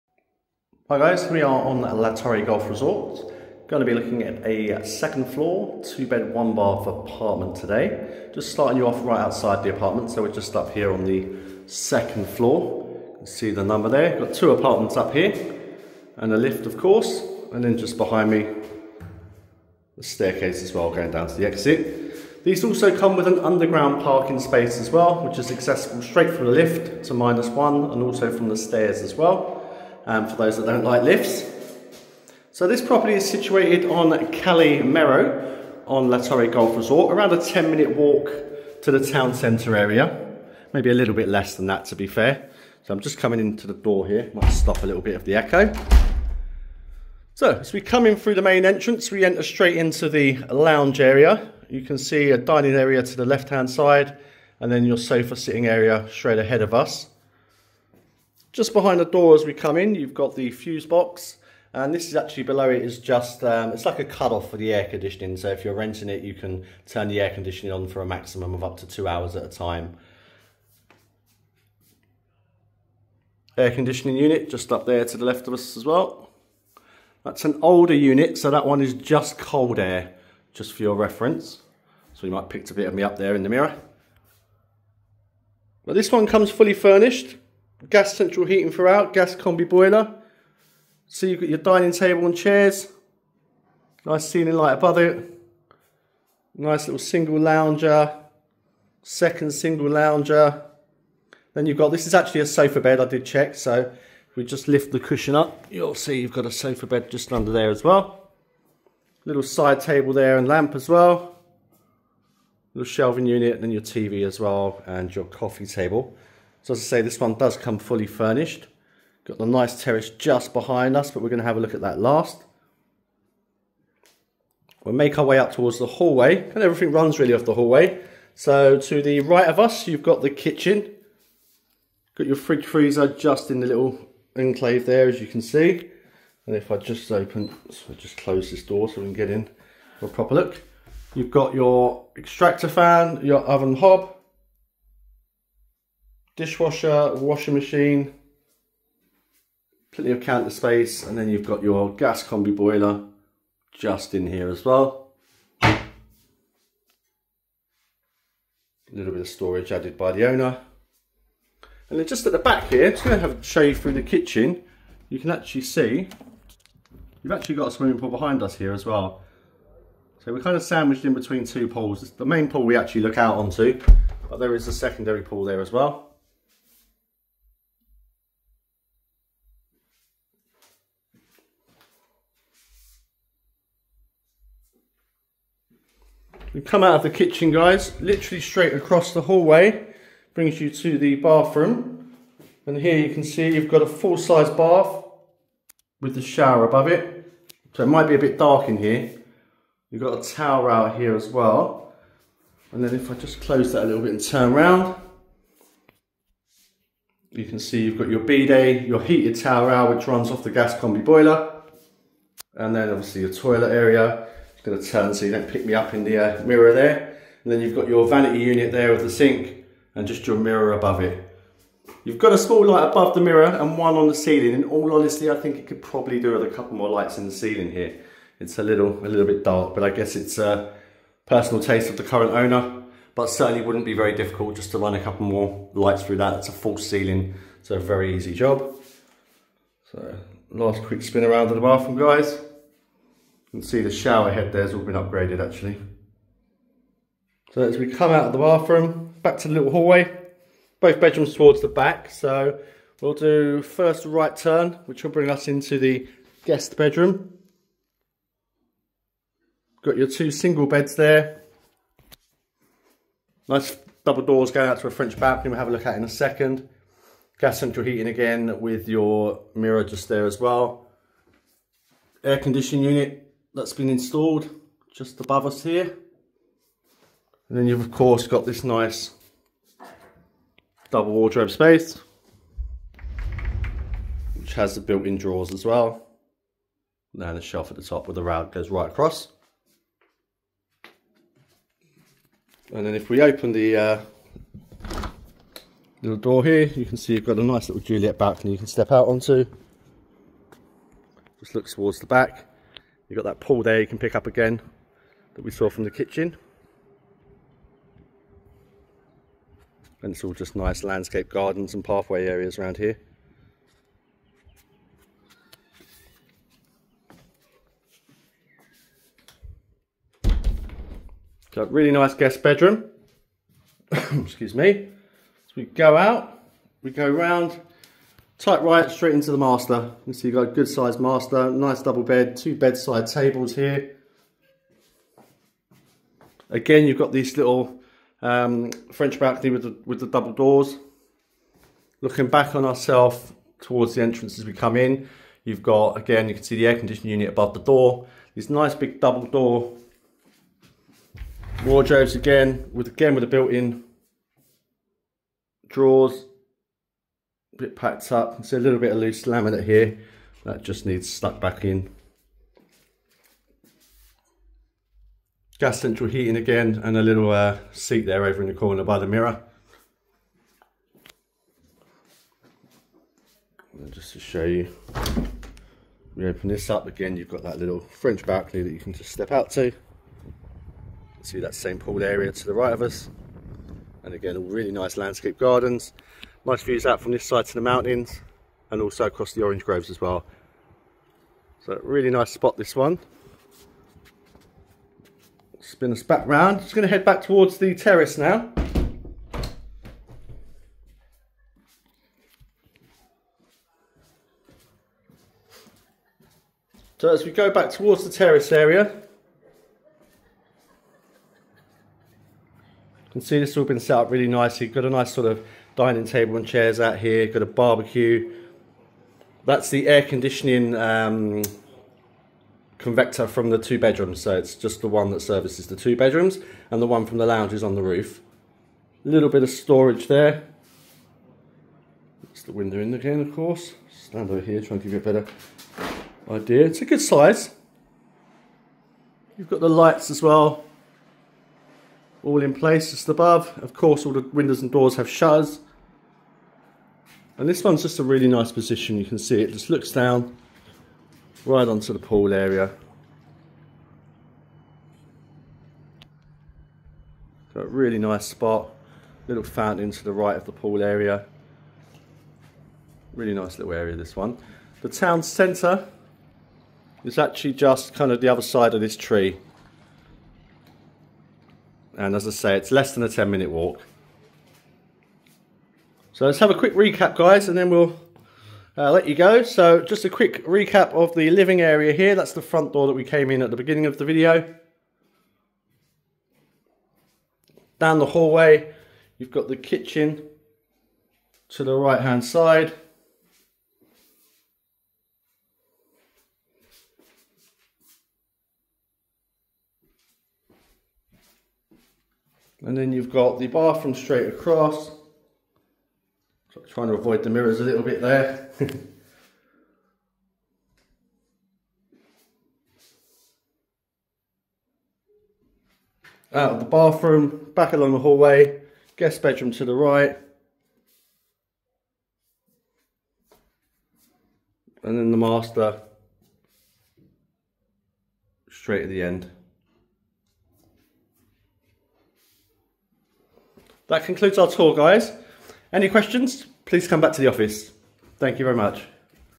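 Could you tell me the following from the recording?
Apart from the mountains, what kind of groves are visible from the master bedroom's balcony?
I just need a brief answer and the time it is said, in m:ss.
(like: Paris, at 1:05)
Orange groves, at 6:29.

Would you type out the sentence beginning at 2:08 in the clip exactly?
So to the right of us, you've got the kitchen.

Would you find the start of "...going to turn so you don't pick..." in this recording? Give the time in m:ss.
3:34.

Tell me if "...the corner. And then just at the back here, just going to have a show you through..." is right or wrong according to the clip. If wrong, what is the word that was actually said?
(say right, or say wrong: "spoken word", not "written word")
wrong: "owner", not "corner".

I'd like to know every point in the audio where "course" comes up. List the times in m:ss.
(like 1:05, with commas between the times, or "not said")
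0:16, 4:37, 7:13, 7:23.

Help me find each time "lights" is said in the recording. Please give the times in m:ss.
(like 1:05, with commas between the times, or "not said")
1:34, 3:42, 3:46, 3:55, 7:19.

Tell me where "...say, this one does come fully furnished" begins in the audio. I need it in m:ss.
1:56.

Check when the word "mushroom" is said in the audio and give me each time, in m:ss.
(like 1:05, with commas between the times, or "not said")
not said.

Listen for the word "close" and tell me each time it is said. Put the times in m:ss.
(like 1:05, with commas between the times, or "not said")
2:18, 3:23.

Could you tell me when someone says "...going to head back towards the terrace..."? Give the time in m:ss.
6:36.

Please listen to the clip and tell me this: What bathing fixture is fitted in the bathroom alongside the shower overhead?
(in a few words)
Full-size bath.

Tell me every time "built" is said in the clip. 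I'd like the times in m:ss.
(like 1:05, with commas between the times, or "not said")
4:44, 5:53.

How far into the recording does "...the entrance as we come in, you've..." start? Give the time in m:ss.
5:43.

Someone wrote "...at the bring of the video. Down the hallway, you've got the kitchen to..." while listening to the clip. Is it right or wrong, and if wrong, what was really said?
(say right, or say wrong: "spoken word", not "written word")
wrong: "beginning", not "bring".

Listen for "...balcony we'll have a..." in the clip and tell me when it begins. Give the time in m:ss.
4:25.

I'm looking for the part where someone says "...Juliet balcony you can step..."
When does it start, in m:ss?
4:57.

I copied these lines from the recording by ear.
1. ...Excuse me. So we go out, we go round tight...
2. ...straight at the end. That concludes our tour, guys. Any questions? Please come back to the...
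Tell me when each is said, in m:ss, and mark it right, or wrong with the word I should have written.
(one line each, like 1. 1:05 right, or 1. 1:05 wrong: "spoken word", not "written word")
1. 5:23 right
2. 8:48 right.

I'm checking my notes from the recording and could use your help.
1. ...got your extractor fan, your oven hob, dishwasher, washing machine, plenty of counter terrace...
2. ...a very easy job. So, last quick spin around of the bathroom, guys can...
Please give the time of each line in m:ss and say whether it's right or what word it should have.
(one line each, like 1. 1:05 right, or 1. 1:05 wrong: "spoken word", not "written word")
1. 2:21 wrong: "space", not "terrace"
2. 3:57 right.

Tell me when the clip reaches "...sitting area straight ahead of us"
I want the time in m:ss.
0:55.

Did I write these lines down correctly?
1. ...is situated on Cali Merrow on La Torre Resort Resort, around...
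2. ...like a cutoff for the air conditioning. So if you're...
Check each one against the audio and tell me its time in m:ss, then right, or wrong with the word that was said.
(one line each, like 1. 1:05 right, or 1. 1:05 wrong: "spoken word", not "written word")
1. 0:33 wrong: "Golf", not "Resort"
2. 1:03 right.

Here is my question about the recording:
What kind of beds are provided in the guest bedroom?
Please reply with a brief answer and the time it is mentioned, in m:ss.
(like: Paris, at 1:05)
Two single beds, at 4:20.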